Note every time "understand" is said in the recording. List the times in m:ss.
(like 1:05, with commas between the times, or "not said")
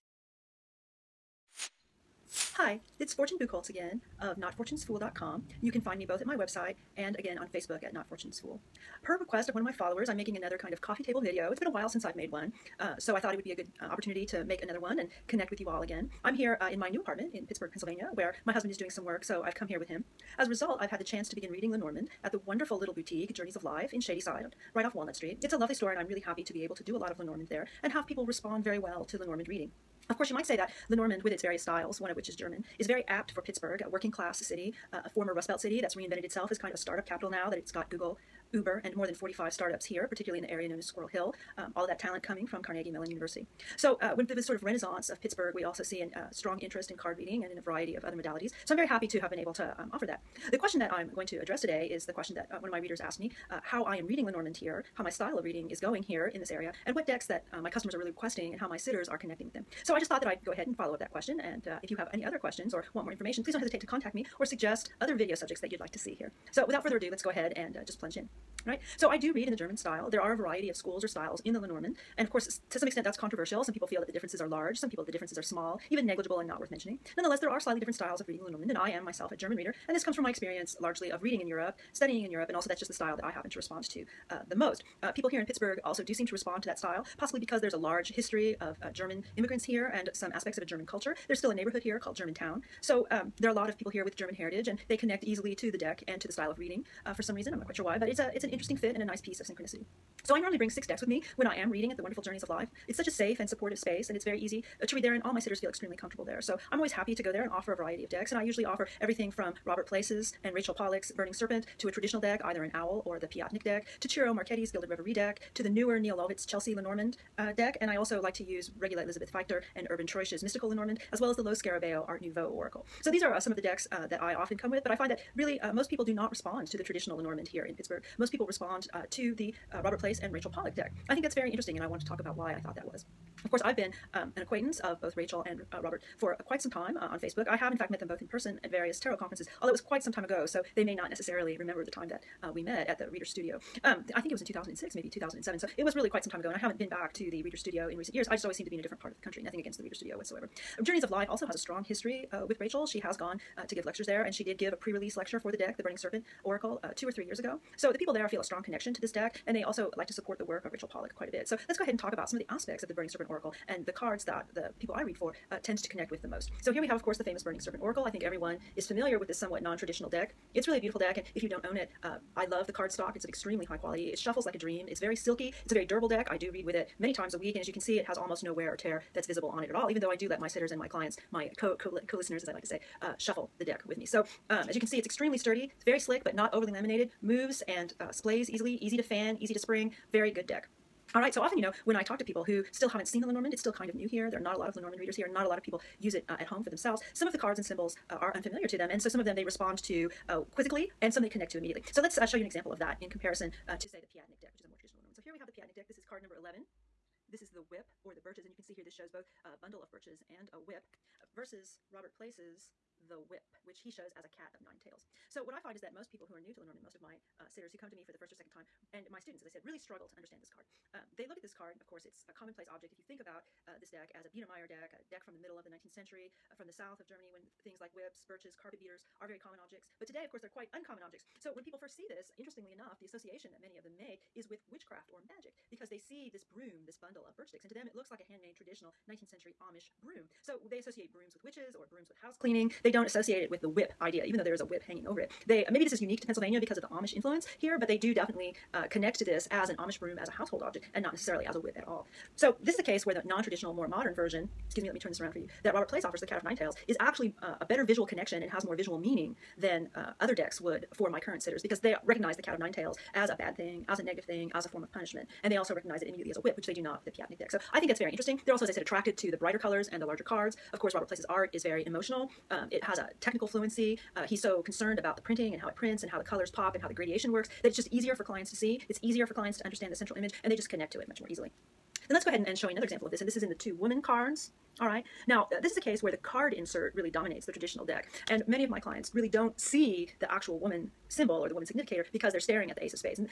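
3:40, 4:39.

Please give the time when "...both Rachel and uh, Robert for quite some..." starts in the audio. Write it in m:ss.
2:15.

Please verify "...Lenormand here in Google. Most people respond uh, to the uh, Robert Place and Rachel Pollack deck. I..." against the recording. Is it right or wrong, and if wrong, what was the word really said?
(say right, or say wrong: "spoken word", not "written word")
wrong: "Pittsburgh", not "Google".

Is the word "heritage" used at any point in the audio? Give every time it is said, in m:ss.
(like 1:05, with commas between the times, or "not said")
1:34.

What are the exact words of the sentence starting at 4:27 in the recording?
So I think that's very interesting.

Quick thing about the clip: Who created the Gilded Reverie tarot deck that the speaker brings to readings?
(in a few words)
Ciro Marchetti.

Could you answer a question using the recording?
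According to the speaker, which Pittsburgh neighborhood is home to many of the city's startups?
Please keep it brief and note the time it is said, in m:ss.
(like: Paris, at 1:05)
Squirrel Hill, at 0:40.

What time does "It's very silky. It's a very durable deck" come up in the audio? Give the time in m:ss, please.
2:54.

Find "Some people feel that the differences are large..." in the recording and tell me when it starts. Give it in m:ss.
1:13.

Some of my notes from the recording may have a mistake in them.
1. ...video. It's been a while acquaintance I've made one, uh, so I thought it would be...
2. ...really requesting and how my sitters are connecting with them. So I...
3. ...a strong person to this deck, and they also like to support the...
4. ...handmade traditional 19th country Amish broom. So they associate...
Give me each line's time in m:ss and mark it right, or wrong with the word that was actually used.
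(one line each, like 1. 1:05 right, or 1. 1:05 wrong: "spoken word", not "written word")
1. 0:11 wrong: "since", not "acquaintance"
2. 0:57 right
3. 2:38 wrong: "connection", not "person"
4. 3:58 wrong: "century", not "country".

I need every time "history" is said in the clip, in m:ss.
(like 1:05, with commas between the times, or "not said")
1:28, 2:31.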